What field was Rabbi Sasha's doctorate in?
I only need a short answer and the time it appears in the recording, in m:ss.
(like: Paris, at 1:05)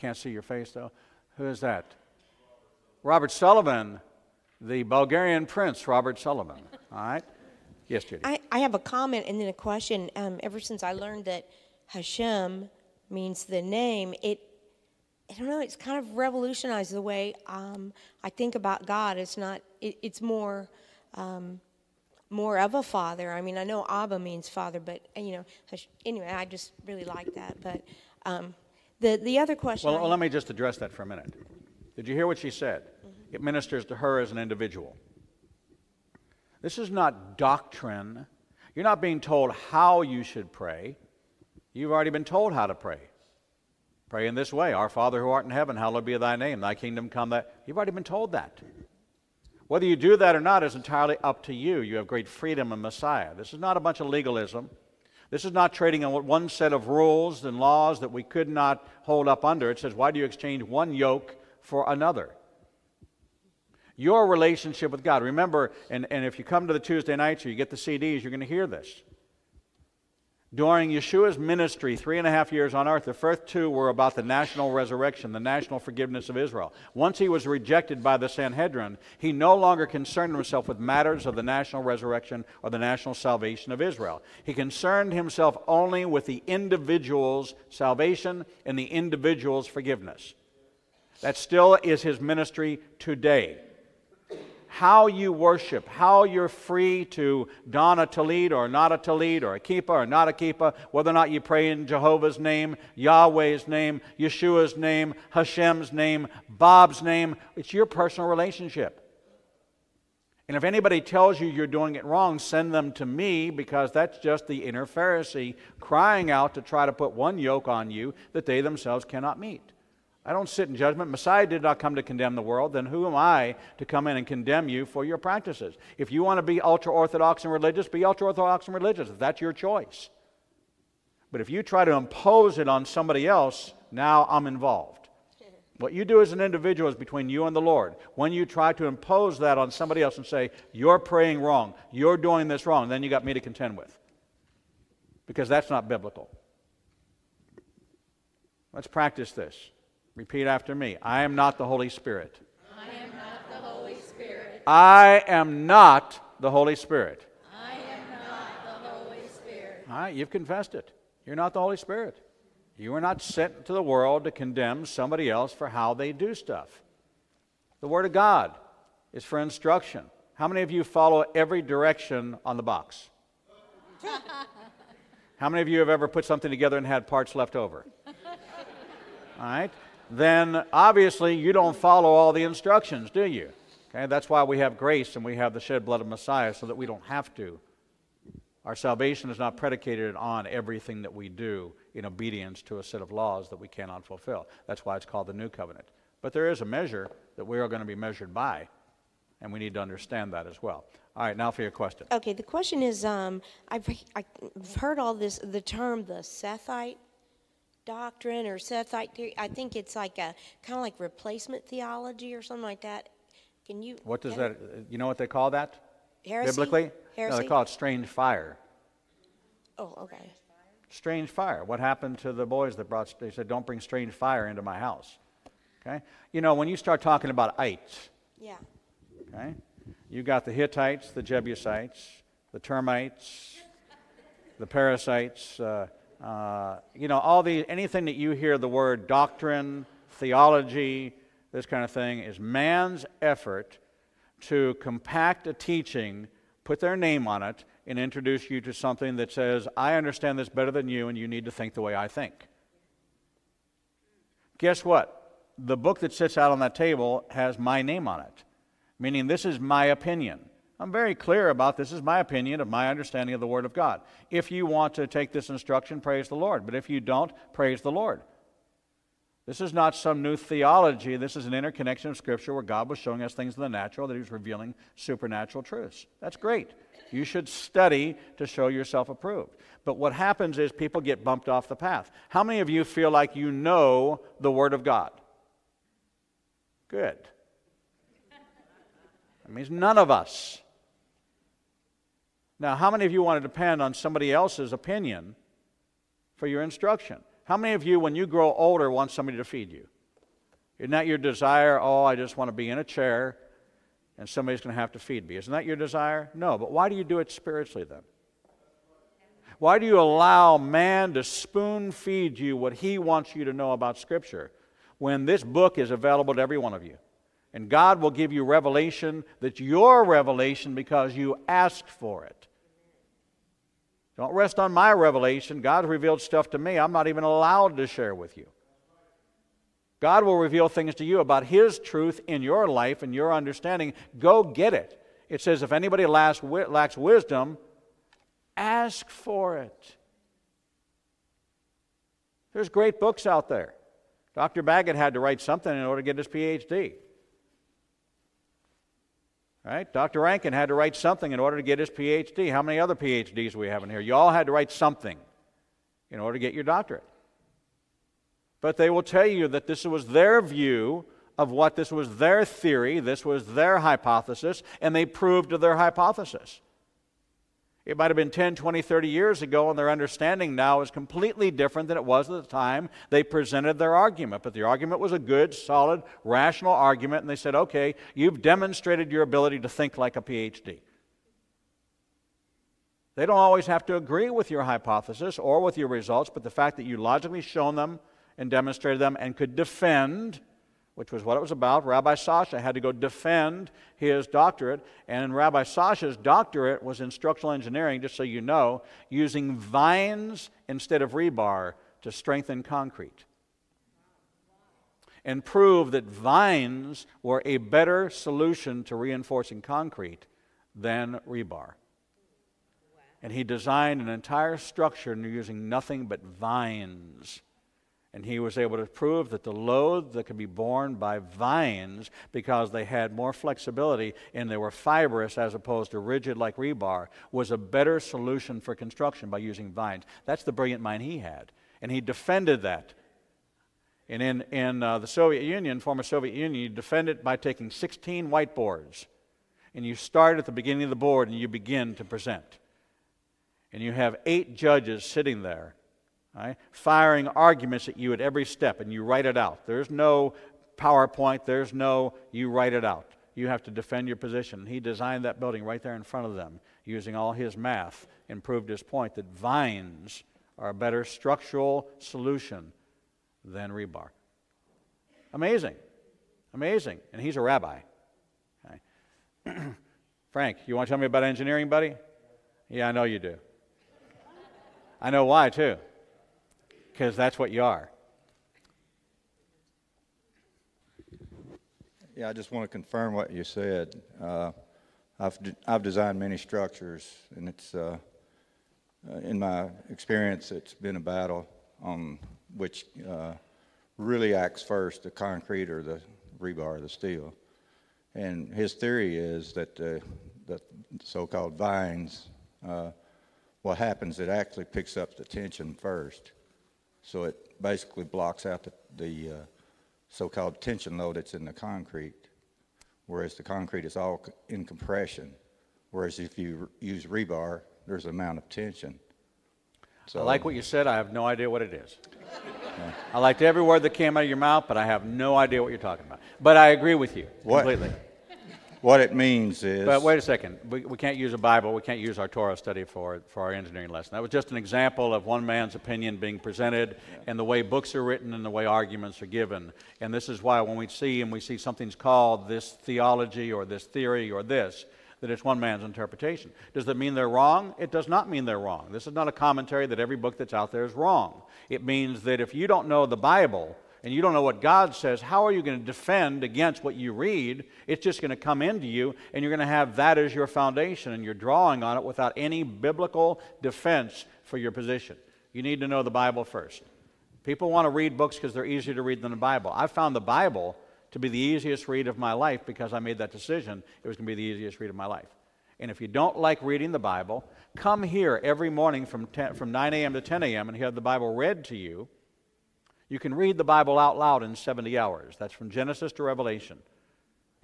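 Structural engineering, at 6:37.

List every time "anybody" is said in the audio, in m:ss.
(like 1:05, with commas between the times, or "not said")
1:50, 5:35.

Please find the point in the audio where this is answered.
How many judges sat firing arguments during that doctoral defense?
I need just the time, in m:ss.
7:24.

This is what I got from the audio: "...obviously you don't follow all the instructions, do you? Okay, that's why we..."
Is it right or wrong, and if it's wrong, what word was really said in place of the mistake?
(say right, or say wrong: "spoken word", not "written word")
right.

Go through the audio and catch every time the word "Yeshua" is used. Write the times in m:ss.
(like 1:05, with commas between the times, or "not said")
1:10, 1:44.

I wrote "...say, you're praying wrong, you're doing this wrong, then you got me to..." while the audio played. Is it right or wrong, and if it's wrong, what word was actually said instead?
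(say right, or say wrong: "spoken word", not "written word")
right.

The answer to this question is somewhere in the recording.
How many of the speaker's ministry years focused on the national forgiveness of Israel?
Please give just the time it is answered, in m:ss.
1:13.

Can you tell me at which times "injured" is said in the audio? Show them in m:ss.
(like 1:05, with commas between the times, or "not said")
not said.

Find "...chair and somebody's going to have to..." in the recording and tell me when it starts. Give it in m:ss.
5:02.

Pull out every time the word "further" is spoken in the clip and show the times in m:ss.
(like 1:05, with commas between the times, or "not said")
not said.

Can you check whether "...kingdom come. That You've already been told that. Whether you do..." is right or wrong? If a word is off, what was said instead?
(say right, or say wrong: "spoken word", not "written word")
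right.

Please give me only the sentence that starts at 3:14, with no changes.
That's why it's called the new covenant.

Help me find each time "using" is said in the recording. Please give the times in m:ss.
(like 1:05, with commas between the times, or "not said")
6:39, 6:55, 7:09, 7:36.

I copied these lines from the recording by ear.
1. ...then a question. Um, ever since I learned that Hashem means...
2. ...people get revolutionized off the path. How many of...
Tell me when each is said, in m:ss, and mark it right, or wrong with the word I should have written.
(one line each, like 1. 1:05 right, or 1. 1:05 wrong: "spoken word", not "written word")
1. 0:09 right
2. 4:40 wrong: "bumped", not "revolutionized".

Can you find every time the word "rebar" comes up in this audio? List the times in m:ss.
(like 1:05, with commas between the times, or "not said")
6:41, 6:51, 7:06, 7:43, 8:16, 8:37.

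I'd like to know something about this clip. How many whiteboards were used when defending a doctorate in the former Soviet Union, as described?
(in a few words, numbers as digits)
16.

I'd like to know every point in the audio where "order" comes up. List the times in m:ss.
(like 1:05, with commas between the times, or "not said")
5:45, 5:51, 5:56.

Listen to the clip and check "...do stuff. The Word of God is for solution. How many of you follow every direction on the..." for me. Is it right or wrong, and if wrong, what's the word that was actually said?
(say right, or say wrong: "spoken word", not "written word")
wrong: "instruction", not "solution".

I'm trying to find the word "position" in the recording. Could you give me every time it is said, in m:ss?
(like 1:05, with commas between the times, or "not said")
7:34, 9:24.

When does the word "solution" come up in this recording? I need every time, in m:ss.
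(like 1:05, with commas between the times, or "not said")
6:48, 7:07, 7:41.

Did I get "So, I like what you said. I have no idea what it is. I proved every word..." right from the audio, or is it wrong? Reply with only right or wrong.
wrong.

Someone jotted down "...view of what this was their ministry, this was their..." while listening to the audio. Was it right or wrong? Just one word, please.
wrong.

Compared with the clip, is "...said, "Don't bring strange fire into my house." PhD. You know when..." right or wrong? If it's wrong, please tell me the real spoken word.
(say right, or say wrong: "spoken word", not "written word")
wrong: "Okay", not "PhD".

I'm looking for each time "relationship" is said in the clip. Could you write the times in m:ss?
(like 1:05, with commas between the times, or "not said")
1:04, 1:48.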